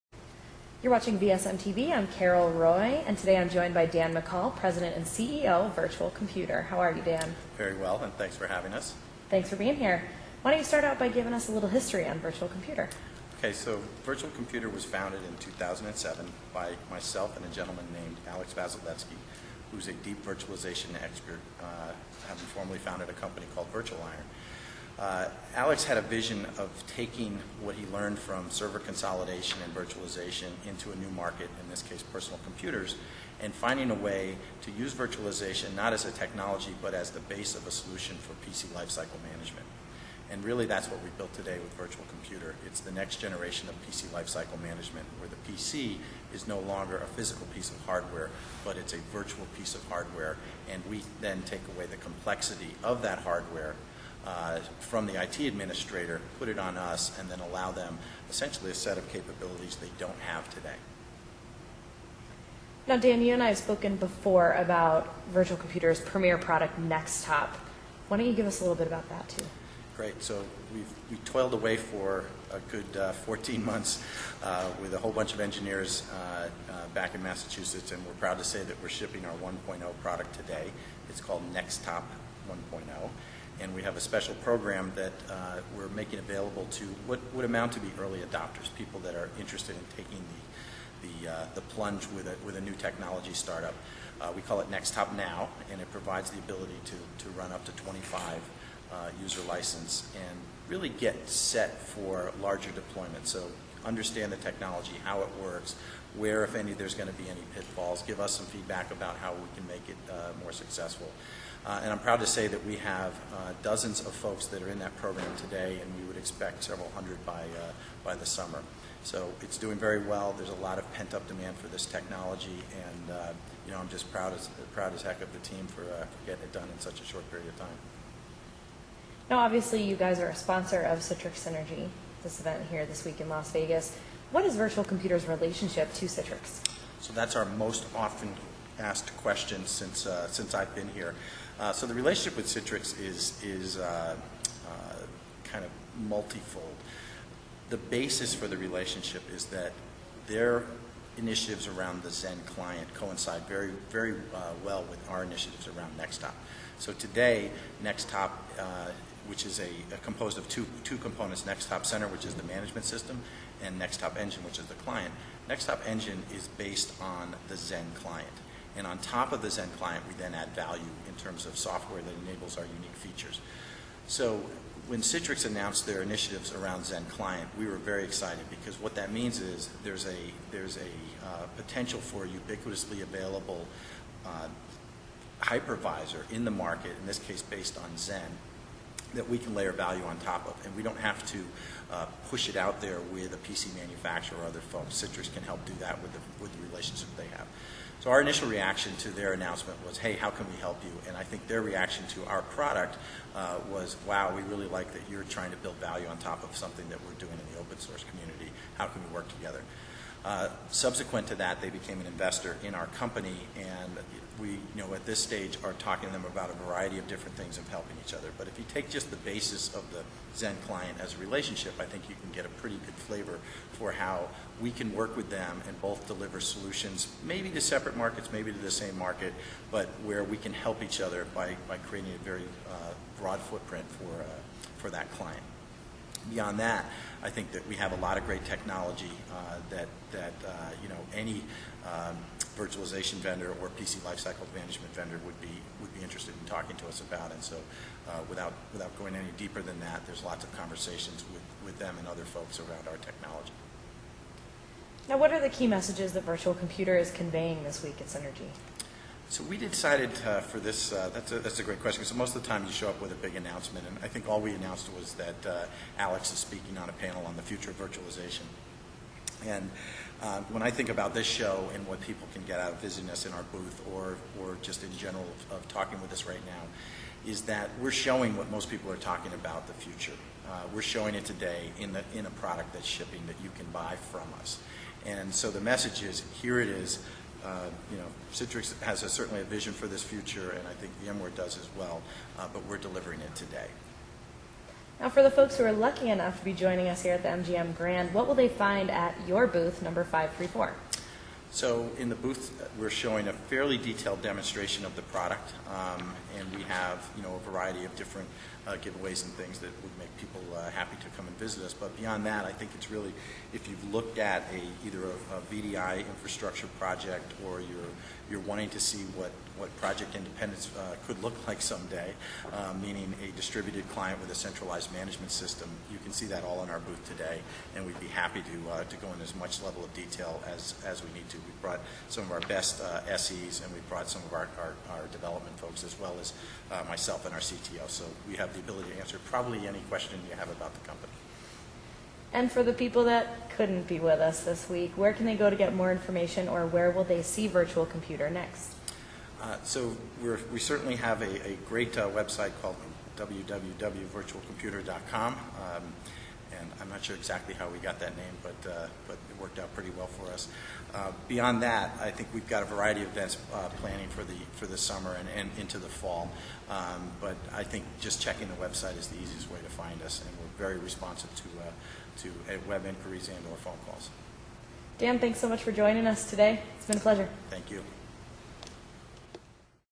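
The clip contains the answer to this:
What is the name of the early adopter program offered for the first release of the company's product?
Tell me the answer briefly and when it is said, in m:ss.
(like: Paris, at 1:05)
NxTop Now, at 1:34.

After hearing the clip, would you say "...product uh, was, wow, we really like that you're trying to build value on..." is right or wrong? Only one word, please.
right.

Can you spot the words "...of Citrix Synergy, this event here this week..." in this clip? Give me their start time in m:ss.
2:10.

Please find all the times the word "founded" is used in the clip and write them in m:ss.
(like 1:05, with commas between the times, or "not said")
0:14, 0:22.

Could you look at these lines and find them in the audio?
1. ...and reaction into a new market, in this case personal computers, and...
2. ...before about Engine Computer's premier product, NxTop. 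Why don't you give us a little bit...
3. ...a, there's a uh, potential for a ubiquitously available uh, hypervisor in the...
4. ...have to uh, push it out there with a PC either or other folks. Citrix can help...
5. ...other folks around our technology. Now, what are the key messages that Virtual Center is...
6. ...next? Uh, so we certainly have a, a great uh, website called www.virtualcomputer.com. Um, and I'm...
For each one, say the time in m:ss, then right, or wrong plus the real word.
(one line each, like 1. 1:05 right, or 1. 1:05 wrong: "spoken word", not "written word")
1. 0:29 wrong: "virtualization", not "reaction"
2. 1:03 wrong: "Virtual", not "Engine"
3. 3:00 right
4. 3:10 wrong: "manufacturer", not "either"
5. 4:12 wrong: "Computer", not "Center"
6. 5:48 right.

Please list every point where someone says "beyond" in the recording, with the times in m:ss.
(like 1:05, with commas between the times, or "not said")
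3:56, 5:11, 6:01.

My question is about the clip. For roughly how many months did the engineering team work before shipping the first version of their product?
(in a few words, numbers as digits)
14 months.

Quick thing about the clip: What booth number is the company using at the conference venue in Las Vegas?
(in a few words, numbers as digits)
534.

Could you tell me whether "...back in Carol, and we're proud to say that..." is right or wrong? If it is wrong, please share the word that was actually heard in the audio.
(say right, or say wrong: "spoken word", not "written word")
wrong: "Massachusetts", not "Carol".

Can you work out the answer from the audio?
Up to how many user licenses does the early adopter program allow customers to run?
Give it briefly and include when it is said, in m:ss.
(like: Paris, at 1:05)
25, at 1:37.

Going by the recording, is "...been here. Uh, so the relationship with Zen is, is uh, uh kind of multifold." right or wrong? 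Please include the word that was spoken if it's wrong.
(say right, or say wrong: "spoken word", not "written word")
wrong: "Citrix", not "Zen".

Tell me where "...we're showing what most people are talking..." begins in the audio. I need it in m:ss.
4:37.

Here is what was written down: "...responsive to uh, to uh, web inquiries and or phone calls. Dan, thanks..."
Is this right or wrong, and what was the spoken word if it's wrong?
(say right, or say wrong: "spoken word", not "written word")
right.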